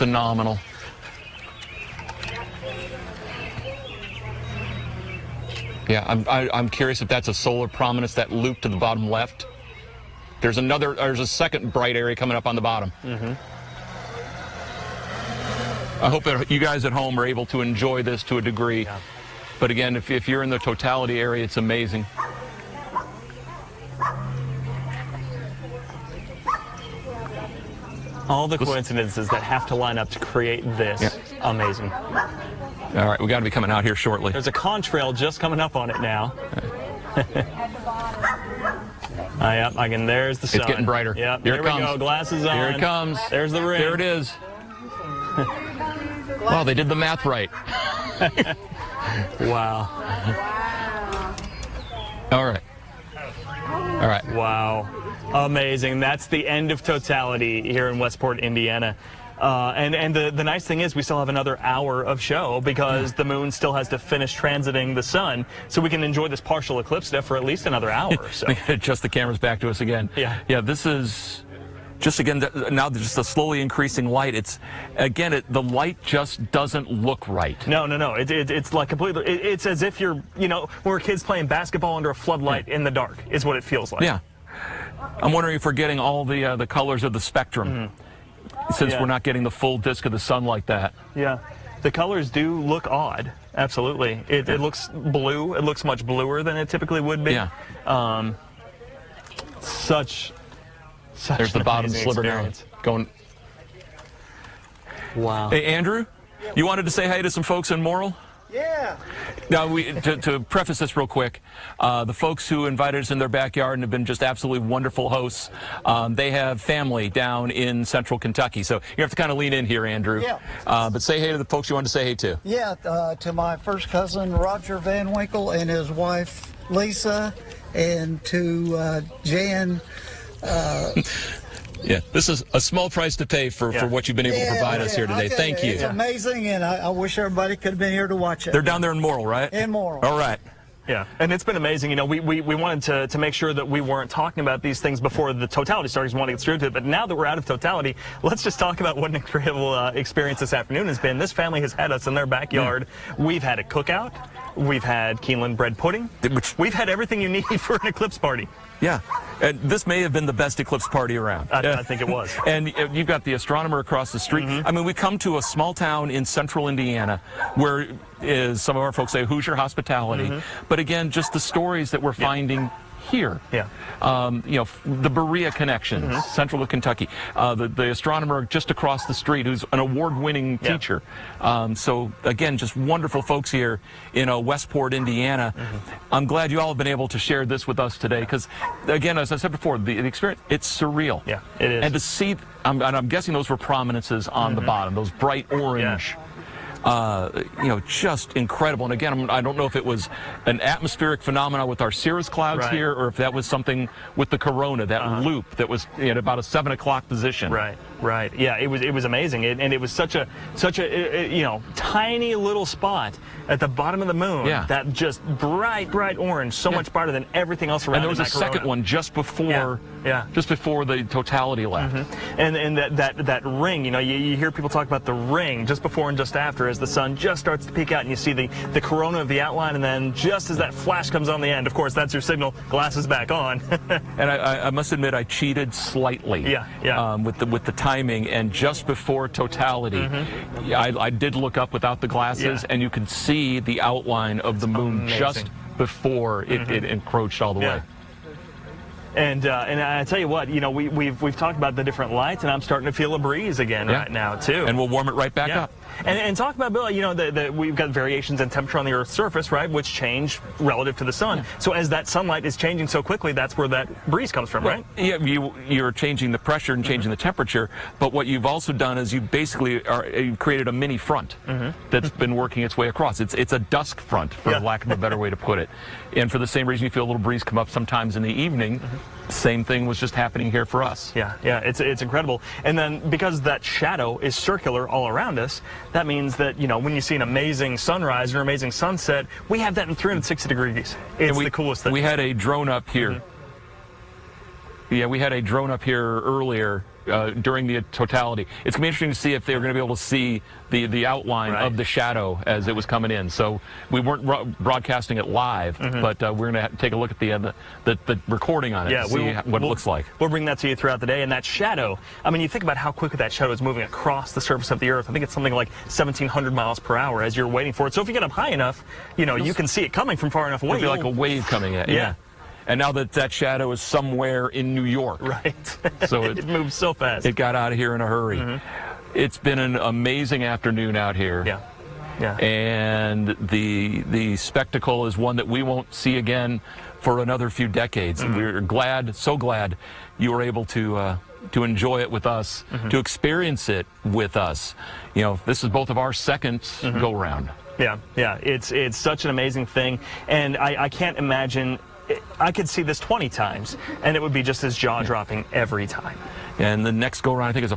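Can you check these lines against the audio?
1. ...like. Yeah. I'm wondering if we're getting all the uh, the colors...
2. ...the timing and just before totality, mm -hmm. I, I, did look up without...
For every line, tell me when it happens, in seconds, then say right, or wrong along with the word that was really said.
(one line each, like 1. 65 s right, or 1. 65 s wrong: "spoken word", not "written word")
1. 83 s right
2. 237 s right.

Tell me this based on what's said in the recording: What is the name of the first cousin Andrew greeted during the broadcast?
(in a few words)
Roger Van Winkle.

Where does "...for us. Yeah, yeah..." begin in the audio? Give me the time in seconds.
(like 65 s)
280 s.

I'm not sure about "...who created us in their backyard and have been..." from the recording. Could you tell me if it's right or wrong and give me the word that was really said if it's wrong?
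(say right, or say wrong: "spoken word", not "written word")
wrong: "invited", not "created".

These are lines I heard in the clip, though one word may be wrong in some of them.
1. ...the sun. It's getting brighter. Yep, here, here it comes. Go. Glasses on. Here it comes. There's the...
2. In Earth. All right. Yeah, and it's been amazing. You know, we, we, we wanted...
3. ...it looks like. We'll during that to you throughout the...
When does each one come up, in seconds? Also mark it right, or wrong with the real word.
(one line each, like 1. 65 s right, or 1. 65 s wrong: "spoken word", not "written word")
1. 40 s right
2. 139 s wrong: "Morrill", not "Earth"
3. 309 s wrong: "bring", not "during".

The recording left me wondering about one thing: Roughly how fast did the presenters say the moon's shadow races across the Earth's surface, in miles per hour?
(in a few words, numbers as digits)
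1,700 miles per hour.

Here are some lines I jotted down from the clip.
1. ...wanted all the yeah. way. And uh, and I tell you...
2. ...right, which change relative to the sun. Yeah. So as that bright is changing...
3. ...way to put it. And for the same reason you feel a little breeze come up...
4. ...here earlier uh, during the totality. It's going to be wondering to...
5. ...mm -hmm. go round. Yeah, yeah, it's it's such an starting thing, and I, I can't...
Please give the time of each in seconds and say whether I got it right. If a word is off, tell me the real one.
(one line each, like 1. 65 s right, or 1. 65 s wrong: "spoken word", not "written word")
1. 246 s wrong: "encroached", not "wanted"
2. 259 s wrong: "sunlight", not "bright"
3. 275 s right
4. 295 s wrong: "interesting", not "wondering"
5. 346 s wrong: "amazing", not "starting".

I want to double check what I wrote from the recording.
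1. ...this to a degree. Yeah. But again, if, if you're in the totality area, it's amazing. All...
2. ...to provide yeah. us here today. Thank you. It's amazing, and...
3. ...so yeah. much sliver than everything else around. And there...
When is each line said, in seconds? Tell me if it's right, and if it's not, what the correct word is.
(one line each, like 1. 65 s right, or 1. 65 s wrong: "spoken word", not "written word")
1. 18 s right
2. 134 s right
3. 216 s wrong: "brighter", not "sliver".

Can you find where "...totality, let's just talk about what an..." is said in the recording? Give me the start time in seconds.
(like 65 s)
147 s.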